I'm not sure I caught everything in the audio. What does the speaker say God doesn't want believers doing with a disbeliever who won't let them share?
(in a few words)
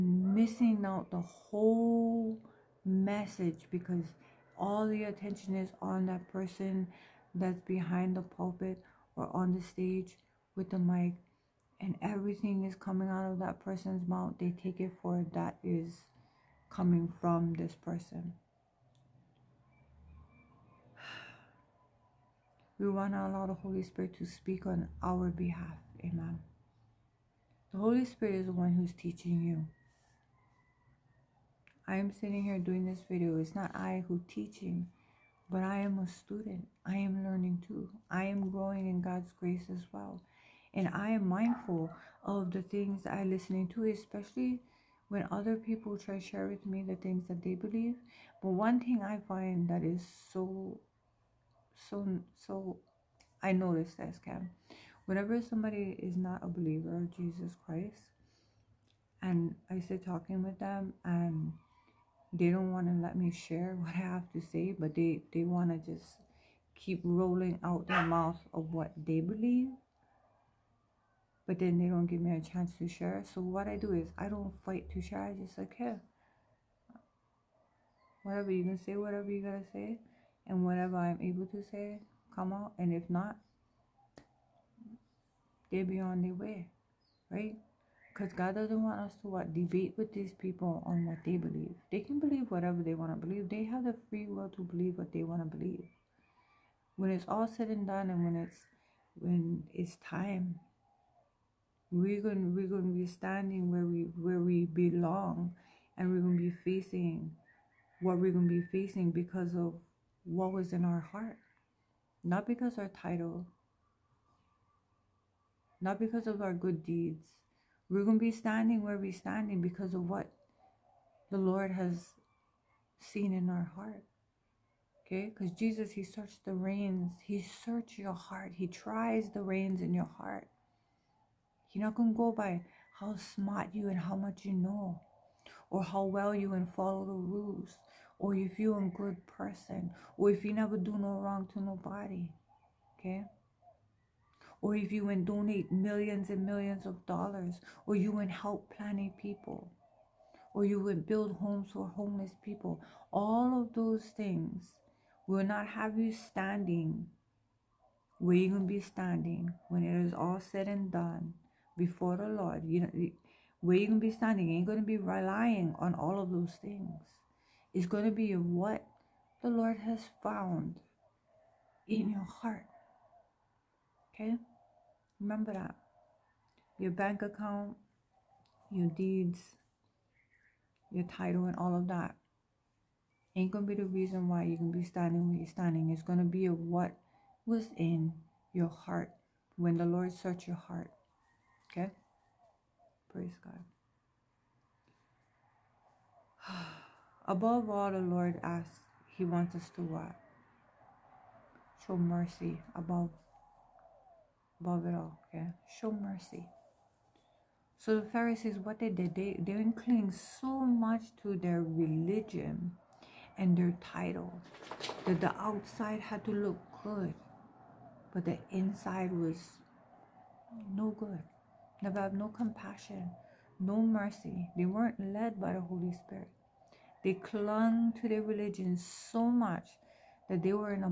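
debate.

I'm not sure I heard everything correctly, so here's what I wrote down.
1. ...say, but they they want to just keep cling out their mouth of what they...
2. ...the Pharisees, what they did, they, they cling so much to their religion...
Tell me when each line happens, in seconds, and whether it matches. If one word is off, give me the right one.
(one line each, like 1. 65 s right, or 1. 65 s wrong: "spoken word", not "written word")
1. 64 s wrong: "rolling", not "cling"
2. 207 s right.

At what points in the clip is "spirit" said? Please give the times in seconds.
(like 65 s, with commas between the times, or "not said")
23 s, 28 s, 225 s.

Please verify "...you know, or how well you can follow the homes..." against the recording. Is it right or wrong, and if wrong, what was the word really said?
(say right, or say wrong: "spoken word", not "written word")
wrong: "rules", not "homes".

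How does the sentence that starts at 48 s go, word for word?
But one thing I find that is so, so, so, I noticed that scam.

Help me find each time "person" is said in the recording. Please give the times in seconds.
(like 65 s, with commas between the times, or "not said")
6 s, 13 s, 17 s, 139 s.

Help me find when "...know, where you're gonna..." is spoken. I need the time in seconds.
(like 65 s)
162 s.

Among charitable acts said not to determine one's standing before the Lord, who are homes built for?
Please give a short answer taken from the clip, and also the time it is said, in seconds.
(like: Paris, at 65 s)
homeless people, at 151 s.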